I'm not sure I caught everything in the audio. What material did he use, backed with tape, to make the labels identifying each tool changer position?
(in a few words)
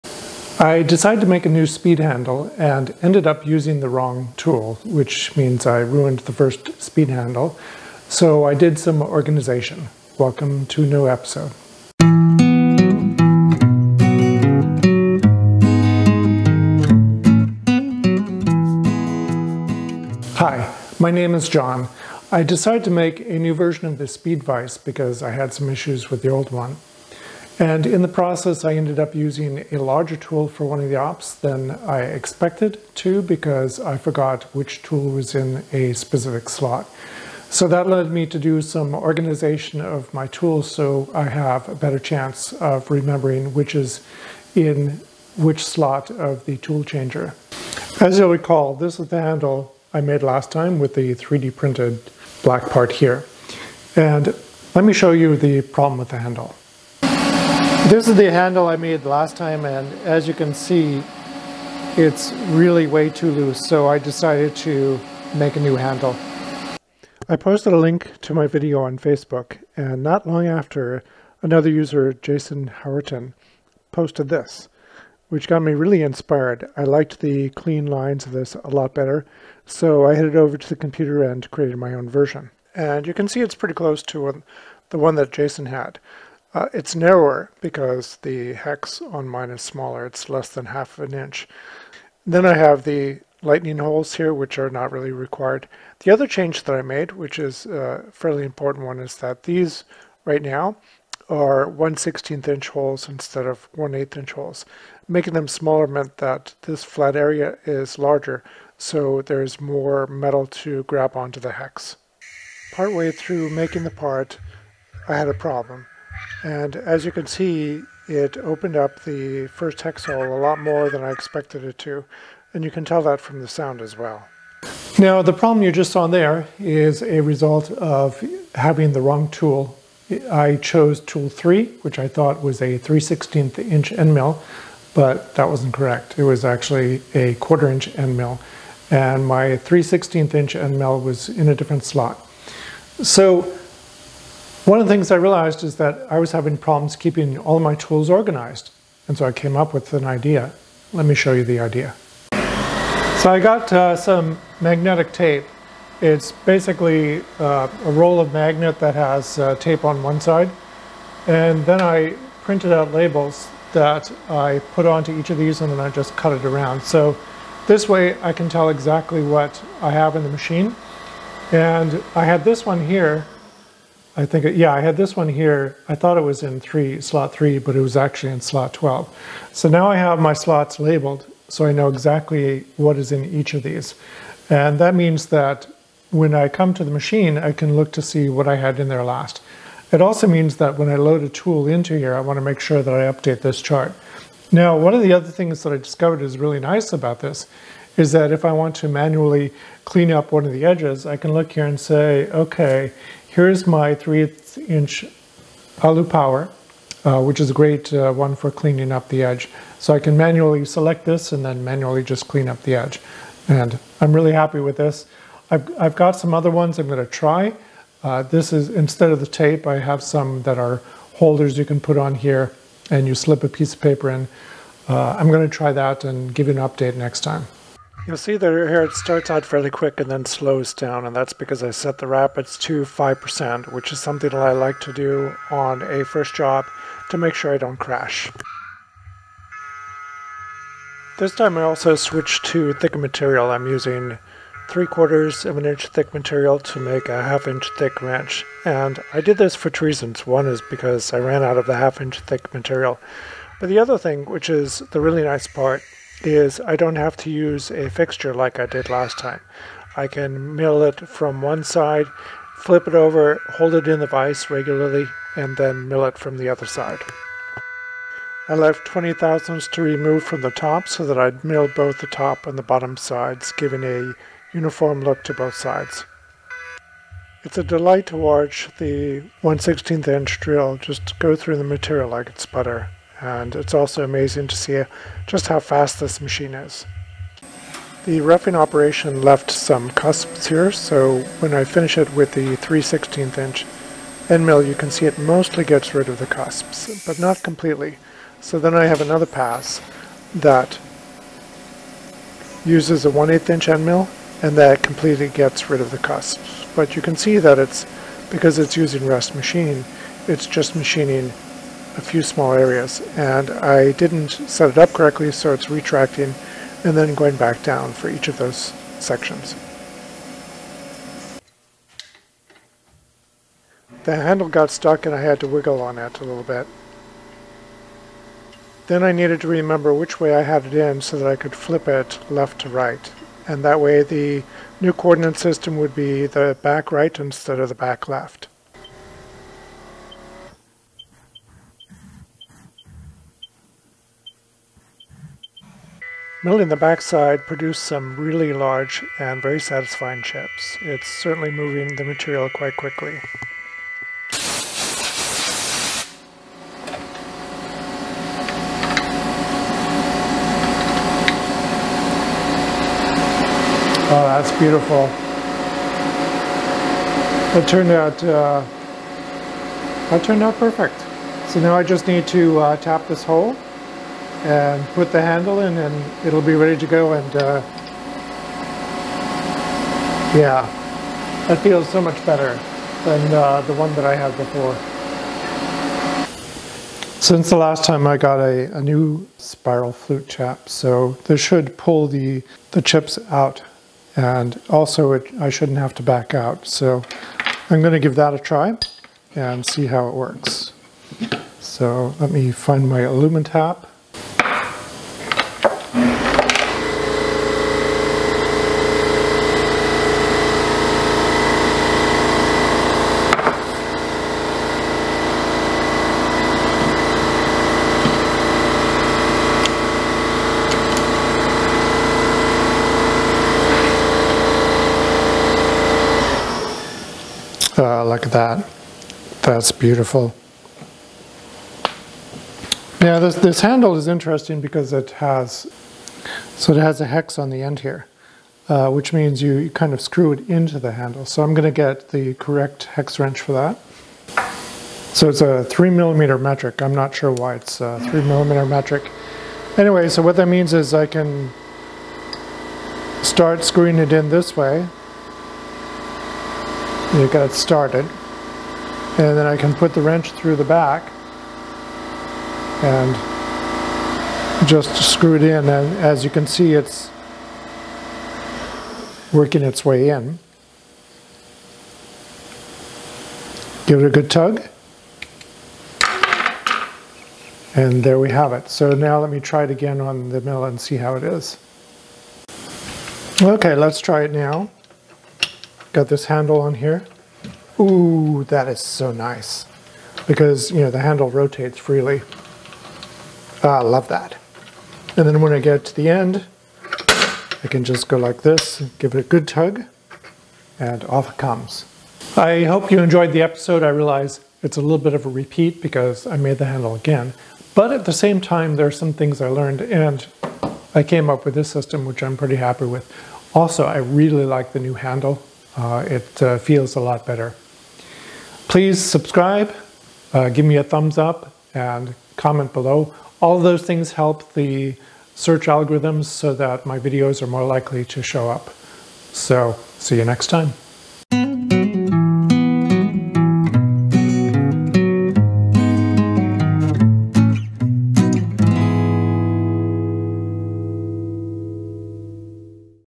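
Magnetic tape.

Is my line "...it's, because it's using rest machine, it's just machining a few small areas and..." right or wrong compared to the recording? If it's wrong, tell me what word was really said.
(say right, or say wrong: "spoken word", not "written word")
right.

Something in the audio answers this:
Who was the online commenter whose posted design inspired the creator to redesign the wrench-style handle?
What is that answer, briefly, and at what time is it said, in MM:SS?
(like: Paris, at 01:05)
Jason Howerton, at 01:12.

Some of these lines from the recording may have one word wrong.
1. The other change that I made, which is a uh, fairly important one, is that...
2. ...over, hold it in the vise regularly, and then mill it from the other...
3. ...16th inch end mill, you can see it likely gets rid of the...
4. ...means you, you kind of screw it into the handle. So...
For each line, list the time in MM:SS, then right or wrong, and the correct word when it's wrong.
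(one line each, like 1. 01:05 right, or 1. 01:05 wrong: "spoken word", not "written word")
1. 01:36 right
2. 04:22 right
3. 04:52 wrong: "mostly", not "likely"
4. 07:19 right.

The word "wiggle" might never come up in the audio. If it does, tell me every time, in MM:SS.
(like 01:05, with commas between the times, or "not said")
05:25.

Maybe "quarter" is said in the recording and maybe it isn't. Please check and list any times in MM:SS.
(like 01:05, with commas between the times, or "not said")
02:17, 04:04.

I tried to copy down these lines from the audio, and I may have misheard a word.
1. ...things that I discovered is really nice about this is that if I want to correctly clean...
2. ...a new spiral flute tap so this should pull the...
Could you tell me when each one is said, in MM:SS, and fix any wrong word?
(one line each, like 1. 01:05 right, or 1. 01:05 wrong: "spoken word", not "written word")
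1. 03:15 wrong: "manually", not "correctly"
2. 06:28 right.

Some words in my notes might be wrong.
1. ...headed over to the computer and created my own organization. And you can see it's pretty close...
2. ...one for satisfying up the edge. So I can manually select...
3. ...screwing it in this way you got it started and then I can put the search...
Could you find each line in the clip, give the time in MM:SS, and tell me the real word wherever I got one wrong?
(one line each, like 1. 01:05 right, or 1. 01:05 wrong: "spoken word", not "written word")
1. 01:20 wrong: "version", not "organization"
2. 03:28 wrong: "cleaning", not "satisfying"
3. 07:33 wrong: "wrench", not "search".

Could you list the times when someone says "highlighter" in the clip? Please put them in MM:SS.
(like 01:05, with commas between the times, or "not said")
not said.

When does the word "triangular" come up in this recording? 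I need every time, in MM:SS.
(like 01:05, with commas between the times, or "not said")
not said.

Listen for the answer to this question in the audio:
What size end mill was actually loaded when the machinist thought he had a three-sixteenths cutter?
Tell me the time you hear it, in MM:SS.
02:17.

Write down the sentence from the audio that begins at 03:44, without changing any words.
Uh, I'm gonna try that and give you an update next time.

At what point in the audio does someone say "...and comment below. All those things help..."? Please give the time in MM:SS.
08:41.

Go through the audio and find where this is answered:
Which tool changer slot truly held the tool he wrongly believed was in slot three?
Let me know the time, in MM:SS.
02:58.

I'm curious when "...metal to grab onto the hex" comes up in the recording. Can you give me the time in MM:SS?
01:50.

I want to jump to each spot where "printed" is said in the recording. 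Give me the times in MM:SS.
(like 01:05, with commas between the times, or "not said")
00:51, 02:42.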